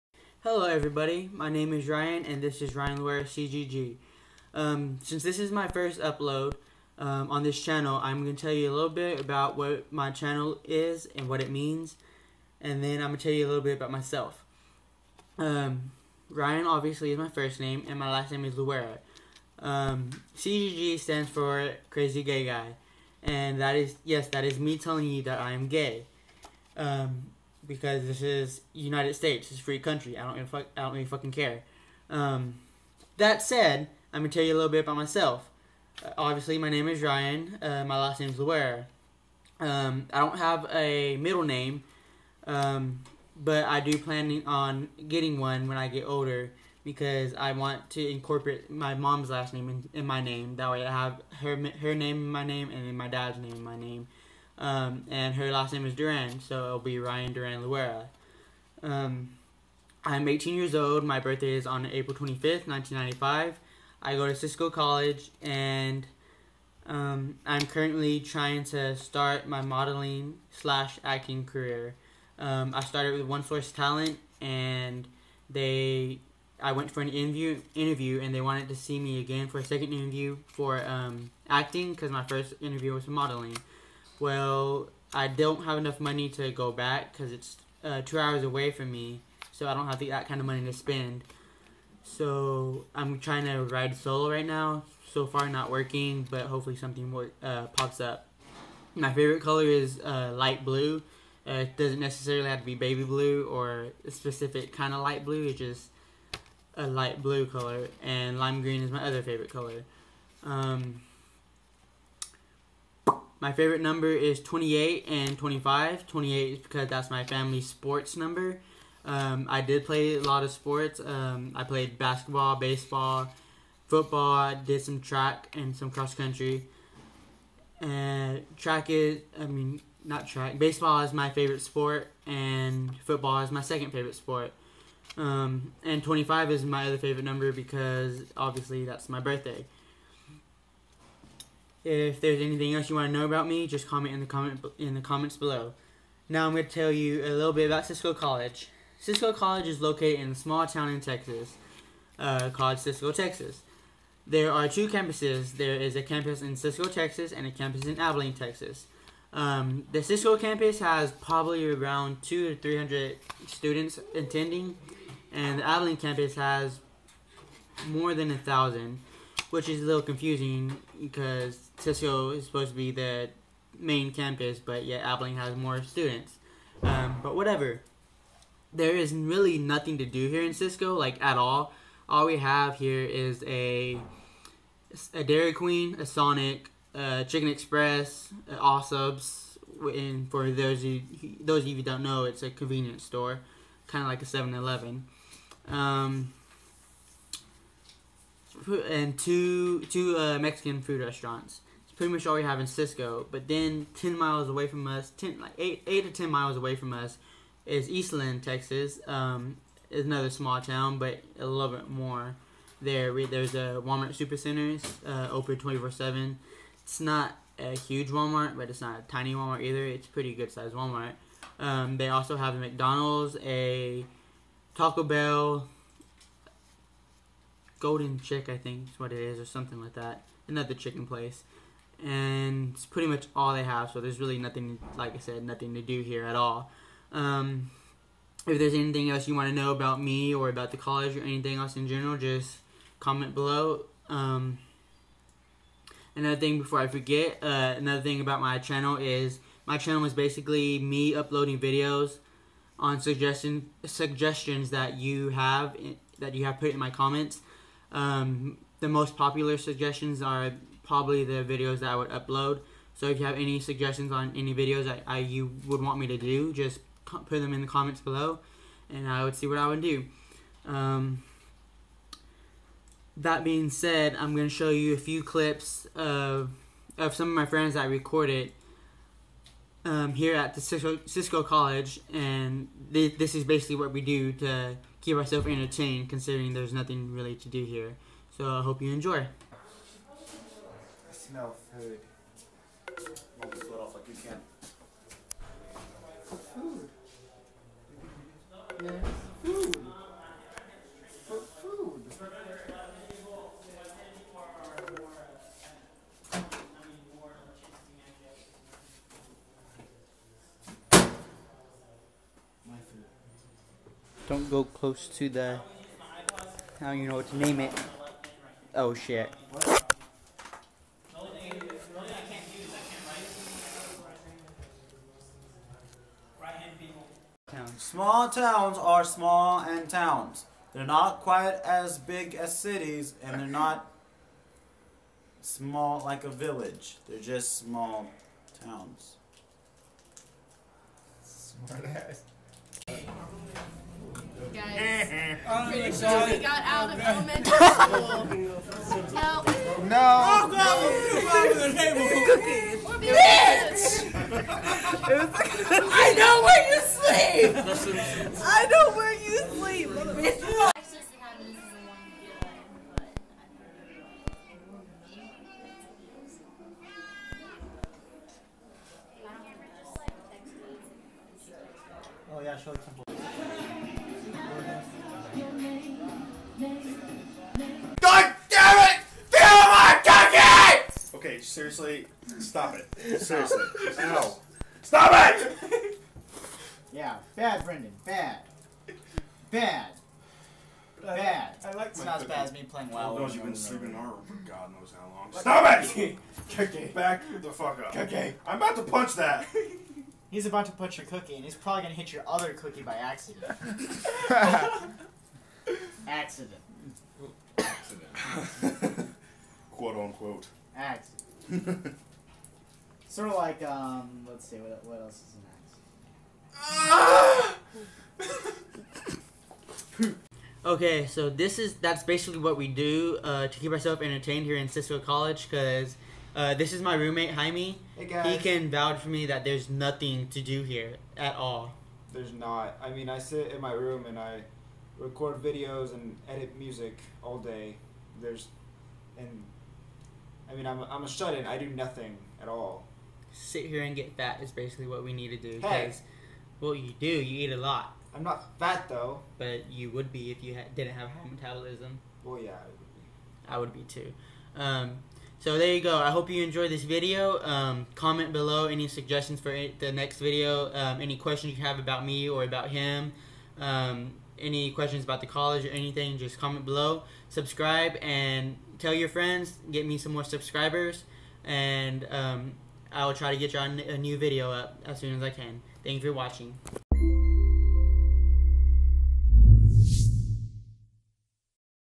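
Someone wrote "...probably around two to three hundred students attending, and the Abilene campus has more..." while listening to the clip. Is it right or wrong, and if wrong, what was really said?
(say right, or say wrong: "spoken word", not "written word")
right.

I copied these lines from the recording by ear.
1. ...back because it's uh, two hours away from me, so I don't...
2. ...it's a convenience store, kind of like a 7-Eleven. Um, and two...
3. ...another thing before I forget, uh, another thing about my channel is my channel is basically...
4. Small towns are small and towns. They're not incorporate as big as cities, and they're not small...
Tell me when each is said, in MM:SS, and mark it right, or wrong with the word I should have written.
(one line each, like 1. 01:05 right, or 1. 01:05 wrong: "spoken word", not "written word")
1. 01:26 right
2. 03:12 right
3. 04:06 right
4. 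05:27 wrong: "quite", not "incorporate".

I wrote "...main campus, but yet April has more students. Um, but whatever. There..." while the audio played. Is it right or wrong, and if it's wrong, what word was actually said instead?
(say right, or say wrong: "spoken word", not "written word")
wrong: "Abilene", not "April".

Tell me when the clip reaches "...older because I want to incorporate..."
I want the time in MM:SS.
00:46.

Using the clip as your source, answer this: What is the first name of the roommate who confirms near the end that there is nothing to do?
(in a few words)
Jaime.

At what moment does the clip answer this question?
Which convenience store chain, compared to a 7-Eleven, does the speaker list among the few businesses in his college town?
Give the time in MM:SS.
03:08.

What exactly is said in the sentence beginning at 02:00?
Um, I played basketball, baseball, football.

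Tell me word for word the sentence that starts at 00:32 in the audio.
Um, that said, I'm gonna tell you a little bit about myself.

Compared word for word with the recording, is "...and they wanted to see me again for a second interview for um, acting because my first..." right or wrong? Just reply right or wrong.
right.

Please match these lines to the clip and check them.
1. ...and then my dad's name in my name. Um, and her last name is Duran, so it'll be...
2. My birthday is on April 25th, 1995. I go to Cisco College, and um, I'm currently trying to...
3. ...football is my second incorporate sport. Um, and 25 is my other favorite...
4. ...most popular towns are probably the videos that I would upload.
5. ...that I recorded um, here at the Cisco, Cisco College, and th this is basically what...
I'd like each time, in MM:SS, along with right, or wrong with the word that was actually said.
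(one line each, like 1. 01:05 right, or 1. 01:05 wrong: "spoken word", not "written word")
1. 00:52 right
2. 01:01 right
3. 02:13 wrong: "favorite", not "incorporate"
4. 04:18 wrong: "suggestions", not "towns"
5. 04:37 right.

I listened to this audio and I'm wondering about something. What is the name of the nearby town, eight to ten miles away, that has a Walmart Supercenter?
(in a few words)
Eastland.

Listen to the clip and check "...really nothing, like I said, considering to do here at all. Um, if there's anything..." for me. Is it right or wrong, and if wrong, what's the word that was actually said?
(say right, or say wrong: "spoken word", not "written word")
wrong: "nothing", not "considering".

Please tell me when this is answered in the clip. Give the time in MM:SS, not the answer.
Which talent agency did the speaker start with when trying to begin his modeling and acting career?
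01:13.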